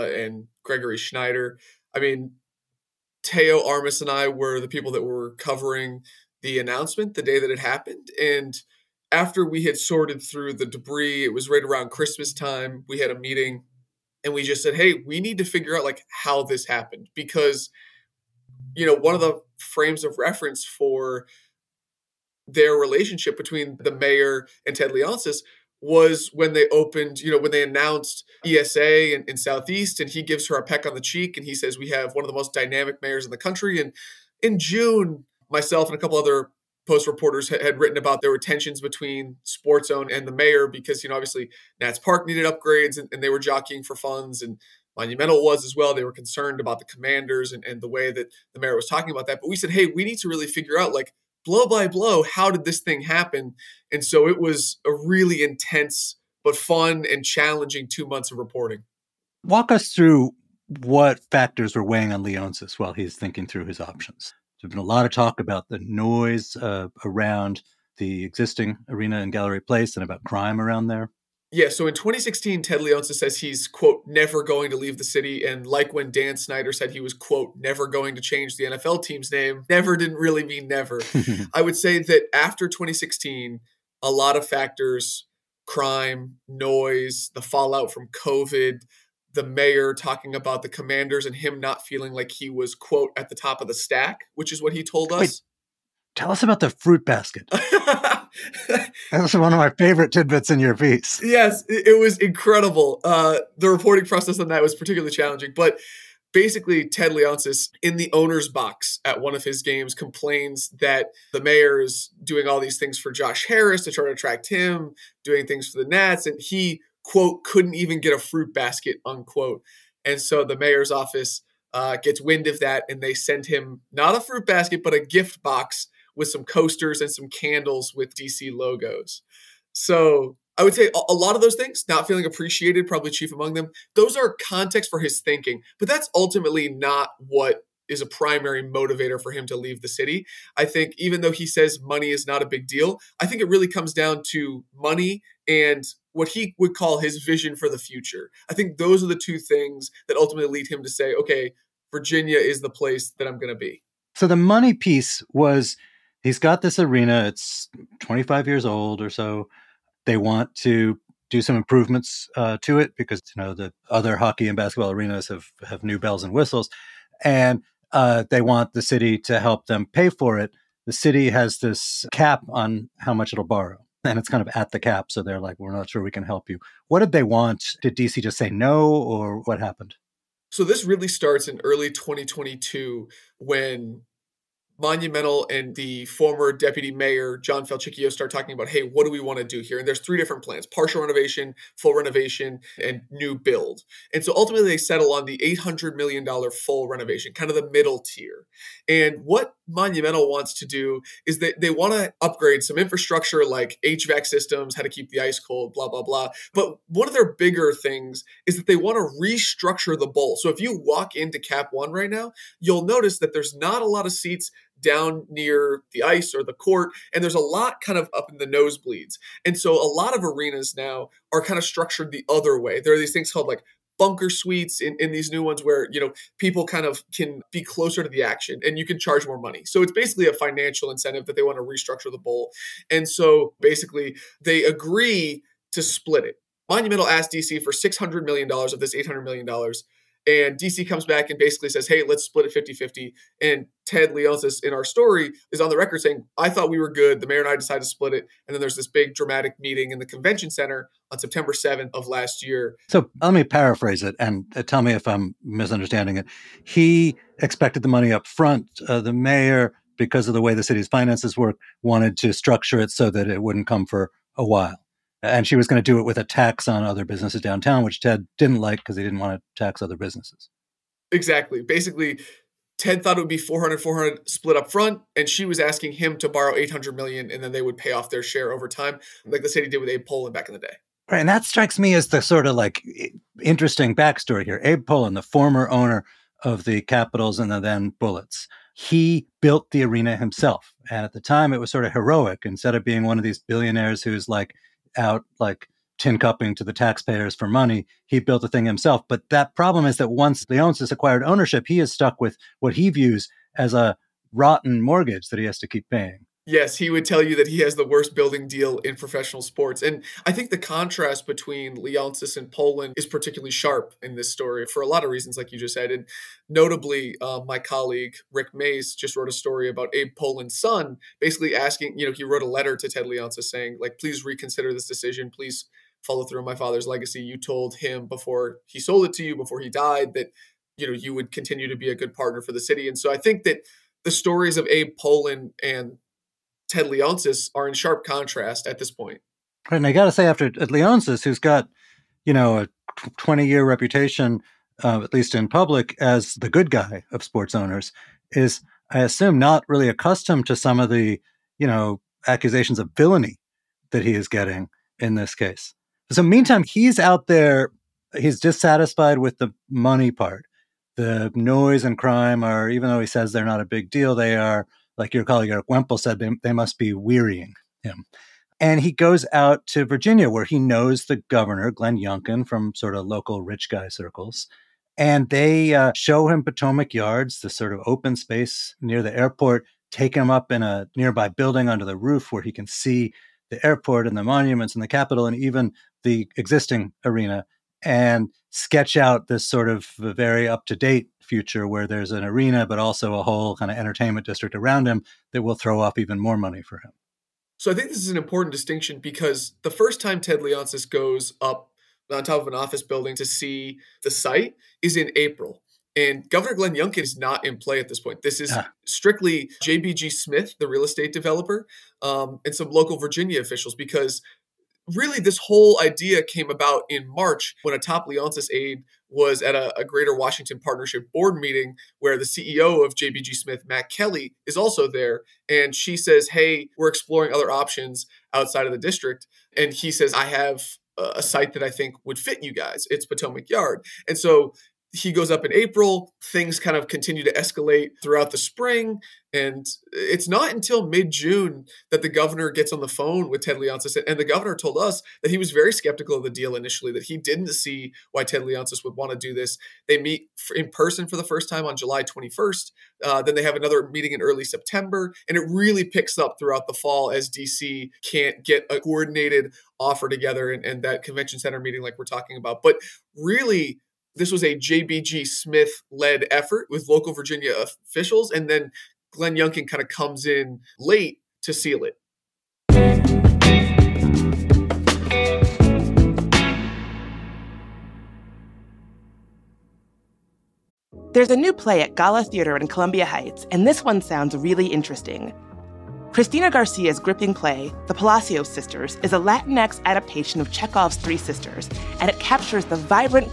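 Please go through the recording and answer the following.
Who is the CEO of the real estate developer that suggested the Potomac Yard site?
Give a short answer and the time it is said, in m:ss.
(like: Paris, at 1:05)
Matt Kelly, at 7:03.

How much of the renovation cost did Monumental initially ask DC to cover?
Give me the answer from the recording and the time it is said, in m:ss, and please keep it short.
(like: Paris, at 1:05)
$600 million, at 3:57.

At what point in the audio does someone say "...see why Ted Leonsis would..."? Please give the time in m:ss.
7:27.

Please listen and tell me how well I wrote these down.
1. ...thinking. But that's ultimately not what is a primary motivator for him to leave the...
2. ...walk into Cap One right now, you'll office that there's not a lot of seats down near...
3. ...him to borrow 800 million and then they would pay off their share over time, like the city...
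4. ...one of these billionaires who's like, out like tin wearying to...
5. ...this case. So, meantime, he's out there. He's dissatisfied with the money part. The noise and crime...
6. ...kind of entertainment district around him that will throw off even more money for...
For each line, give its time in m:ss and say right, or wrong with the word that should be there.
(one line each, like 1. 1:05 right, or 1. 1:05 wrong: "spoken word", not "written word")
1. 2:15 right
2. 3:30 wrong: "notice", not "office"
3. 4:35 right
4. 4:53 wrong: "cupping", not "wearying"
5. 5:55 right
6. 6:33 right.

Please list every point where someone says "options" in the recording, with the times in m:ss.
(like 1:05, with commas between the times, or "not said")
1:03, 7:07.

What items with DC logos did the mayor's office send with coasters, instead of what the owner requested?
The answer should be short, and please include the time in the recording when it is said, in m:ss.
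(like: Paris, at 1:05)
Candles, at 2:07.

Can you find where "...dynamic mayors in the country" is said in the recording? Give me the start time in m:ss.
0:32.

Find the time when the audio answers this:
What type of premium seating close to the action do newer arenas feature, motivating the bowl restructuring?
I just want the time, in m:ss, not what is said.
3:43.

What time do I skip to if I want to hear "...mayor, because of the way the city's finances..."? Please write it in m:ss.
4:19.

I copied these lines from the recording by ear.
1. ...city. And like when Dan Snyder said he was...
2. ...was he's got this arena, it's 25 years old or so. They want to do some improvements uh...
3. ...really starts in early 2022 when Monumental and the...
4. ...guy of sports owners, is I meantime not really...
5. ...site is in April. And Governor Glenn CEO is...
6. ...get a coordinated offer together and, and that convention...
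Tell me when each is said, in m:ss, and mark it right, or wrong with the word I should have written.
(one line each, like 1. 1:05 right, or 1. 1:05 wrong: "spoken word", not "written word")
1. 1:15 right
2. 2:35 right
3. 3:00 right
4. 5:46 wrong: "assume", not "meantime"
5. 6:44 wrong: "Youngkin", not "CEO"
6. 7:38 right.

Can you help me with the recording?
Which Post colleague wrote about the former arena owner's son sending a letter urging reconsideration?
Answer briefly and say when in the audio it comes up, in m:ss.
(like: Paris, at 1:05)
Rick Maese, at 5:18.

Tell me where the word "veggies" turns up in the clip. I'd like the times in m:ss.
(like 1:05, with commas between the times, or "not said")
not said.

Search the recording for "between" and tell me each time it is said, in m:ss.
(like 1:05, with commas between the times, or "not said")
0:23, 0:38, 5:11.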